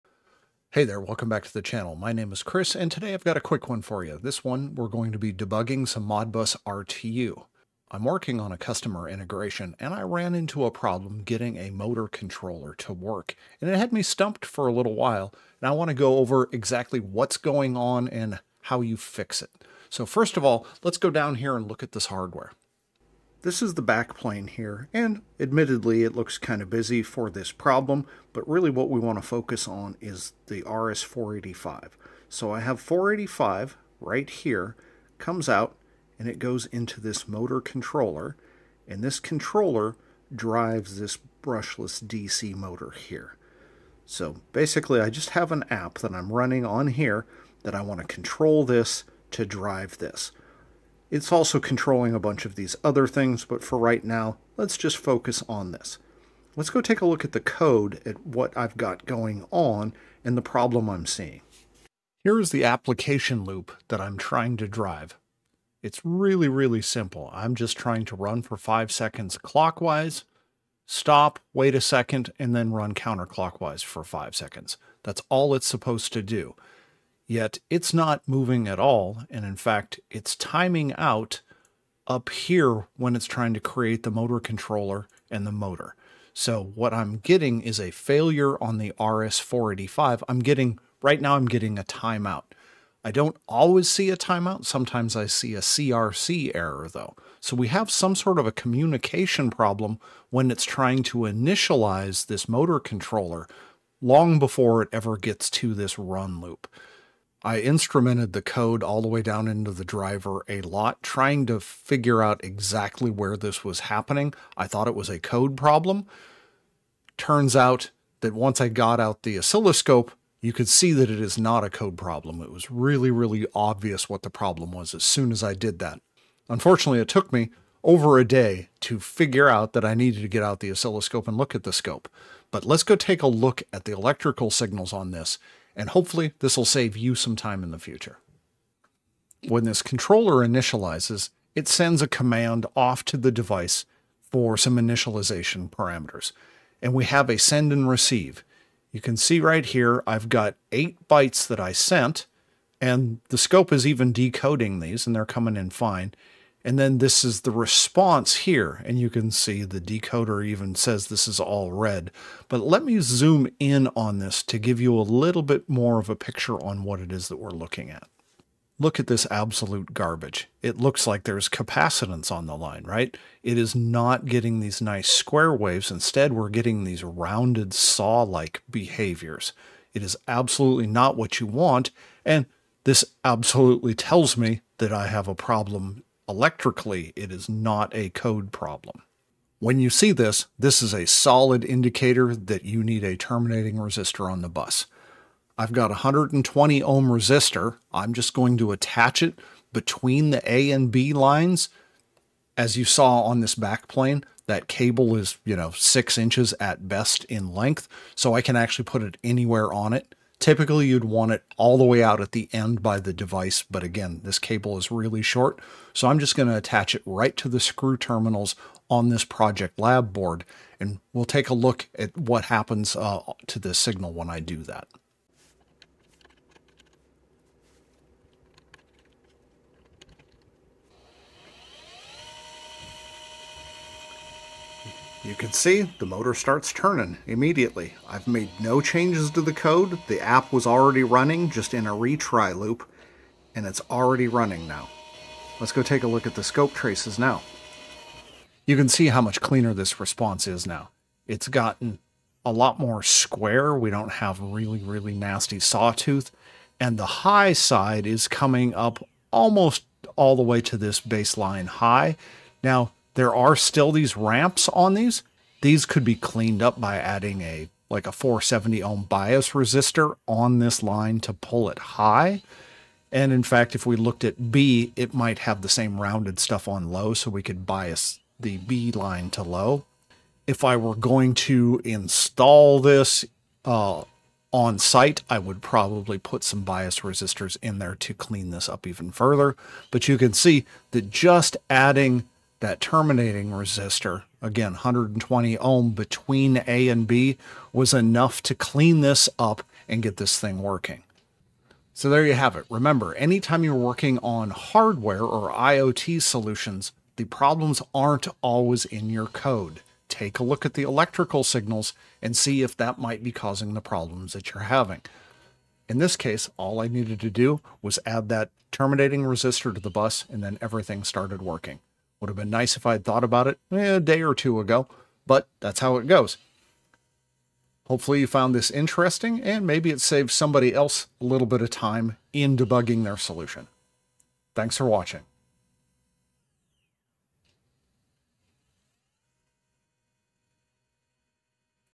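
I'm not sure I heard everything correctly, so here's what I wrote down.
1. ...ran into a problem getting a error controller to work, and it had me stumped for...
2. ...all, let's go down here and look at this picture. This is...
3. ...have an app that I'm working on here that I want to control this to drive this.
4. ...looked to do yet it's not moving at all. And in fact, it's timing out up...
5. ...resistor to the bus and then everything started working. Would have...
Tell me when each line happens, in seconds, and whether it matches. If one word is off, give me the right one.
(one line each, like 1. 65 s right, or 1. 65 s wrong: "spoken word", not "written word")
1. 10 s wrong: "motor", not "error"
2. 20 s wrong: "hardware", not "picture"
3. 45 s wrong: "running", not "working"
4. 75 s wrong: "supposed", not "looked"
5. 319 s right.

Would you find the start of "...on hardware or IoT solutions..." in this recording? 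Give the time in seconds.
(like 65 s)
304 s.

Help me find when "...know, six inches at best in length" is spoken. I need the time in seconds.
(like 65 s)
205 s.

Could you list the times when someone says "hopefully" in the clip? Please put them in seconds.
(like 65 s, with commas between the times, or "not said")
135 s, 327 s.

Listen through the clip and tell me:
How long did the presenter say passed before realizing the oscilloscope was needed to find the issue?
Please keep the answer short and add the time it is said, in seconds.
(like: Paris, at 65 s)
over a day, at 127 s.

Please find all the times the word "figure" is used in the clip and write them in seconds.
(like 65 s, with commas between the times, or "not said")
111 s, 128 s.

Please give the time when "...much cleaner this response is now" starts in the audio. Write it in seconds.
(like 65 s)
249 s.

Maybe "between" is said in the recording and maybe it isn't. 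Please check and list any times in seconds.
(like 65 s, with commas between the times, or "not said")
199 s, 295 s.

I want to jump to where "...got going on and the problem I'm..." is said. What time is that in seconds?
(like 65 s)
58 s.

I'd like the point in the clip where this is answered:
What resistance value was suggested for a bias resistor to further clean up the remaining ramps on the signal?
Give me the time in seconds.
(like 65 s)
268 s.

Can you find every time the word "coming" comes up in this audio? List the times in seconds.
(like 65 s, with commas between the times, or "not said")
155 s, 258 s.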